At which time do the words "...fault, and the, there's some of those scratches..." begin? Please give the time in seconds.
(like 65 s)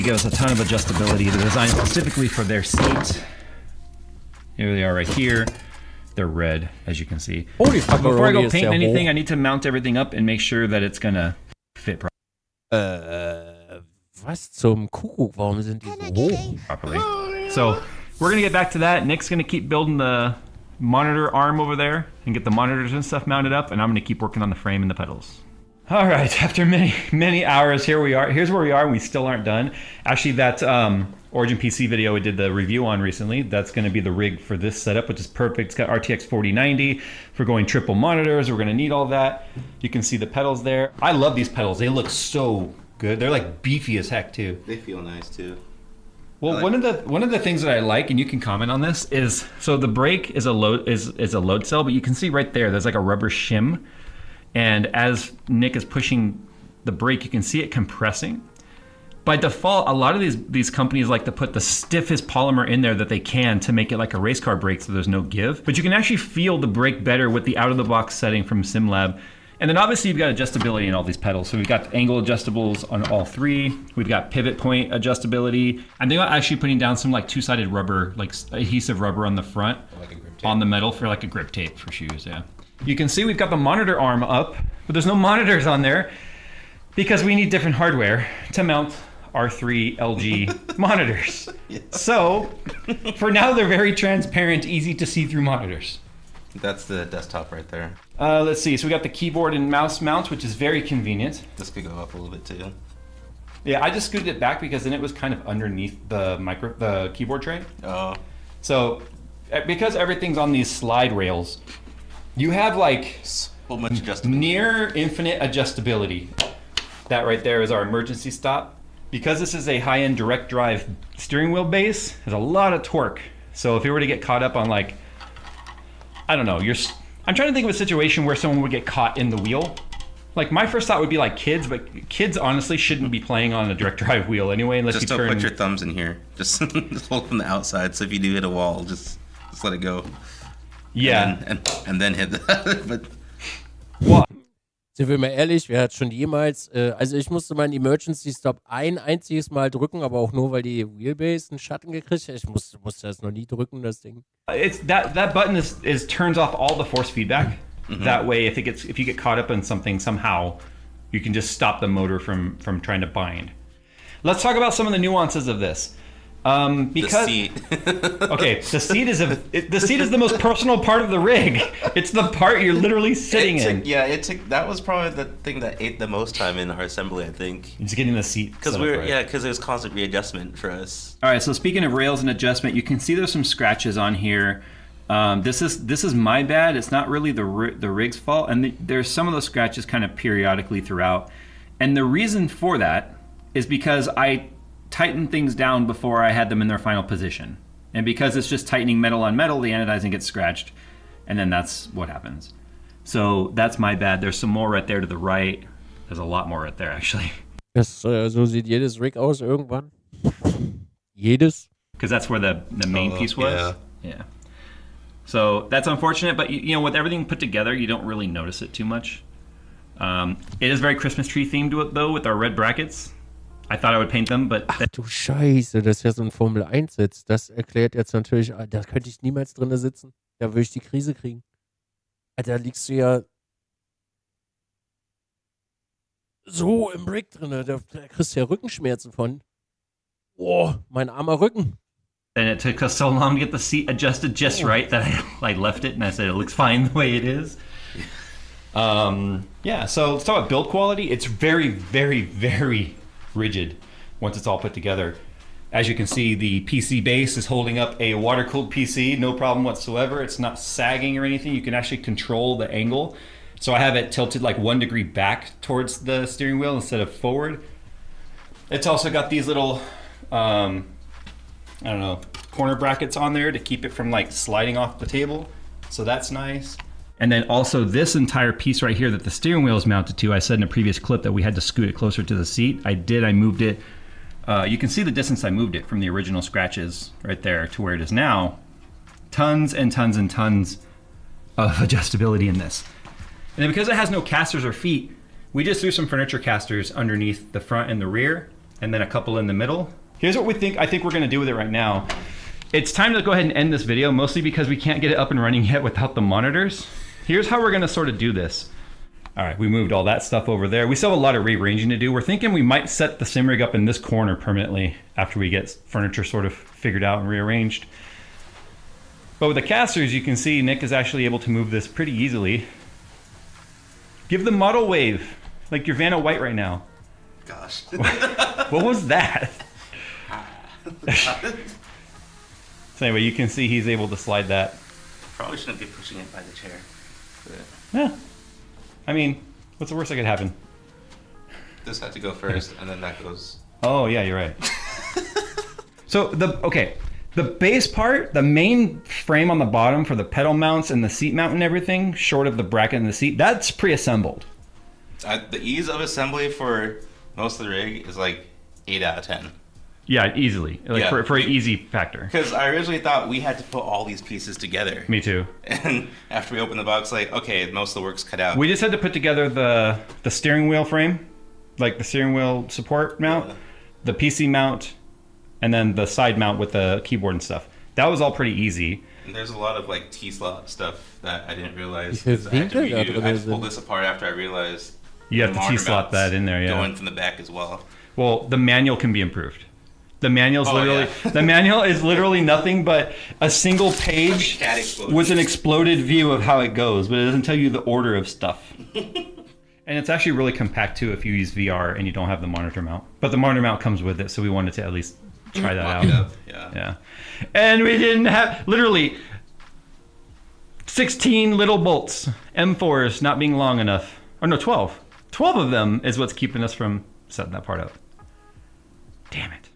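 188 s.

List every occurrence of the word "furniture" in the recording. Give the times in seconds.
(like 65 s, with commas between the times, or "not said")
296 s, 315 s.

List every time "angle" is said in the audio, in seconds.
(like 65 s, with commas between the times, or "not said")
71 s, 262 s.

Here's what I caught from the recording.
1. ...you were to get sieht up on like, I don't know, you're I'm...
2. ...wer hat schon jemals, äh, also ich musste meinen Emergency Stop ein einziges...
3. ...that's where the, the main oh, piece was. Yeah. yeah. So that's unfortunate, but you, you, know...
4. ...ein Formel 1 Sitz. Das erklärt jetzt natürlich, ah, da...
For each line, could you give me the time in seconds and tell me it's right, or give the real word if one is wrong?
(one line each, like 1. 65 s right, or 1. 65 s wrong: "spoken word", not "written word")
1. 123 s wrong: "caught", not "sieht"
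2. 145 s right
3. 212 s right
4. 226 s right.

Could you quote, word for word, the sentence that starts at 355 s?
Uh, the ease of assembly for most of the rig is like eight out of ten.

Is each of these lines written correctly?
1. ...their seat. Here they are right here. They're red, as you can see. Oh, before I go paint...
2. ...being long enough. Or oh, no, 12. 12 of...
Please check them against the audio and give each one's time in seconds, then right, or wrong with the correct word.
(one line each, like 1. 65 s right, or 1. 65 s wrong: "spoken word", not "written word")
1. 2 s right
2. 413 s right.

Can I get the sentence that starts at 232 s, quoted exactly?
Ah, da liegst du ja so im Brick drin.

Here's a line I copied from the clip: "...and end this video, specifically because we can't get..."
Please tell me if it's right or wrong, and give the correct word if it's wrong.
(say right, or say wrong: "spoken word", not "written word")
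wrong: "mostly", not "specifically".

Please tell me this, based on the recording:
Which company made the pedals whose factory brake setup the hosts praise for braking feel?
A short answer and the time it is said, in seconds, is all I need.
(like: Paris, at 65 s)
SimLab, at 68 s.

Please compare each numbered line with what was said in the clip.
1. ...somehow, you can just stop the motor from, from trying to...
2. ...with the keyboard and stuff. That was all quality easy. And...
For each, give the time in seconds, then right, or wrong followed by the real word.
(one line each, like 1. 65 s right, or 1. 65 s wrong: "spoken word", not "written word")
1. 159 s right
2. 376 s wrong: "pretty", not "quality".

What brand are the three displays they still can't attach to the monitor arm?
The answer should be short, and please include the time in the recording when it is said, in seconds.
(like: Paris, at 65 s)
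LG, at 89 s.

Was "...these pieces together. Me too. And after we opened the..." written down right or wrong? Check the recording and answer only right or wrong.
right.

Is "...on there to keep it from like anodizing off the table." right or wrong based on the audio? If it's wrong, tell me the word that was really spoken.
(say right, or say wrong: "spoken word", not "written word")
wrong: "sliding", not "anodizing".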